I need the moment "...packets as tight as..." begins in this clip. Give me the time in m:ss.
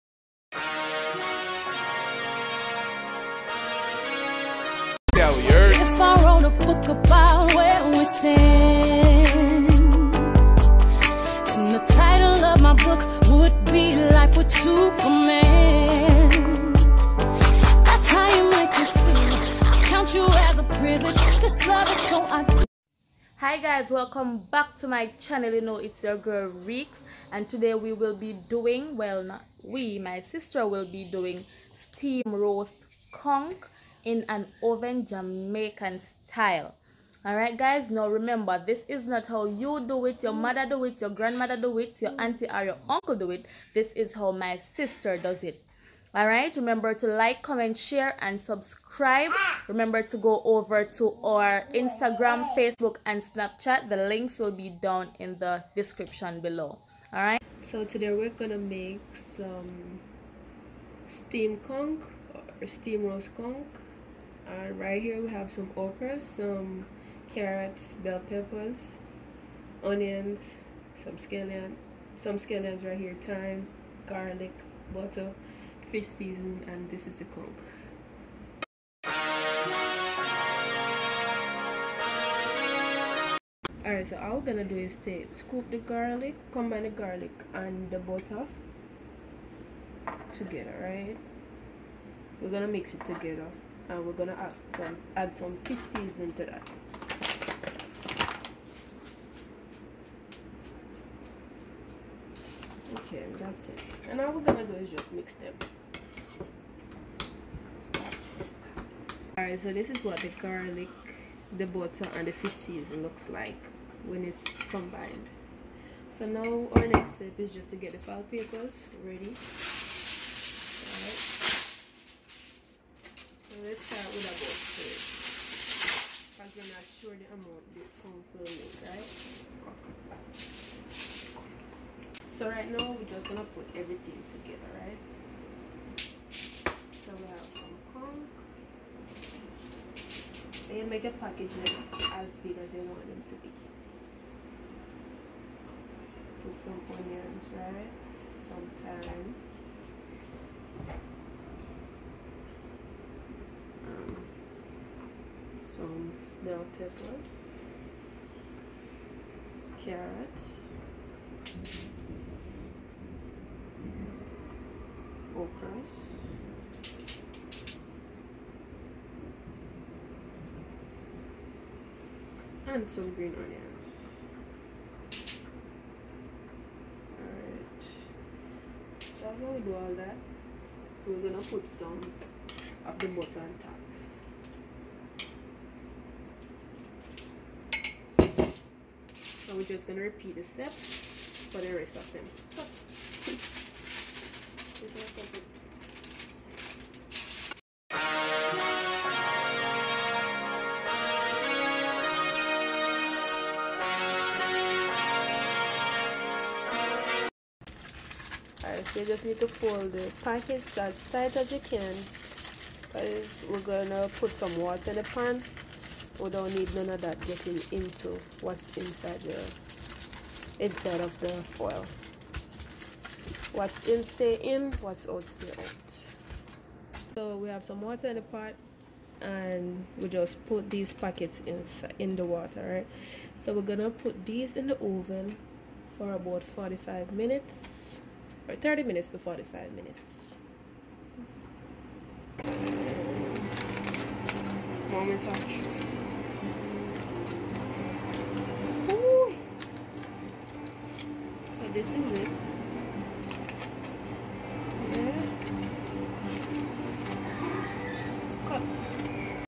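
3:30.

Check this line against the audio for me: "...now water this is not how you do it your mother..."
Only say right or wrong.
wrong.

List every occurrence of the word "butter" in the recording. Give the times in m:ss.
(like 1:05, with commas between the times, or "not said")
1:14, 1:27, 1:51, 3:03.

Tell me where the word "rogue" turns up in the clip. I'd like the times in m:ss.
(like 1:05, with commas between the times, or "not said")
not said.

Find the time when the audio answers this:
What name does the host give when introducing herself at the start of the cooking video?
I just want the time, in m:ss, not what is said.
0:26.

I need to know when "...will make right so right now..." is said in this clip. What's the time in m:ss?
2:08.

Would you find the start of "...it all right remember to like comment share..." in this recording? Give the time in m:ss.
0:45.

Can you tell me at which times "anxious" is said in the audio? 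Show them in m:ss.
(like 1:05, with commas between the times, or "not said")
not said.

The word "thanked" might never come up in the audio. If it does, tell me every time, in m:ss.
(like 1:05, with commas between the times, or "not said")
not said.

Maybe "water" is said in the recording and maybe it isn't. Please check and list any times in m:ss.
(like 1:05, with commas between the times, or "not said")
3:34, 3:47, 3:52.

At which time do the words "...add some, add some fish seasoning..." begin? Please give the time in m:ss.
1:34.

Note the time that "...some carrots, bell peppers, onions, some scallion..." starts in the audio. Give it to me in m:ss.
1:06.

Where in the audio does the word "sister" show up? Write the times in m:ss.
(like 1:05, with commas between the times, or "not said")
0:30, 0:44.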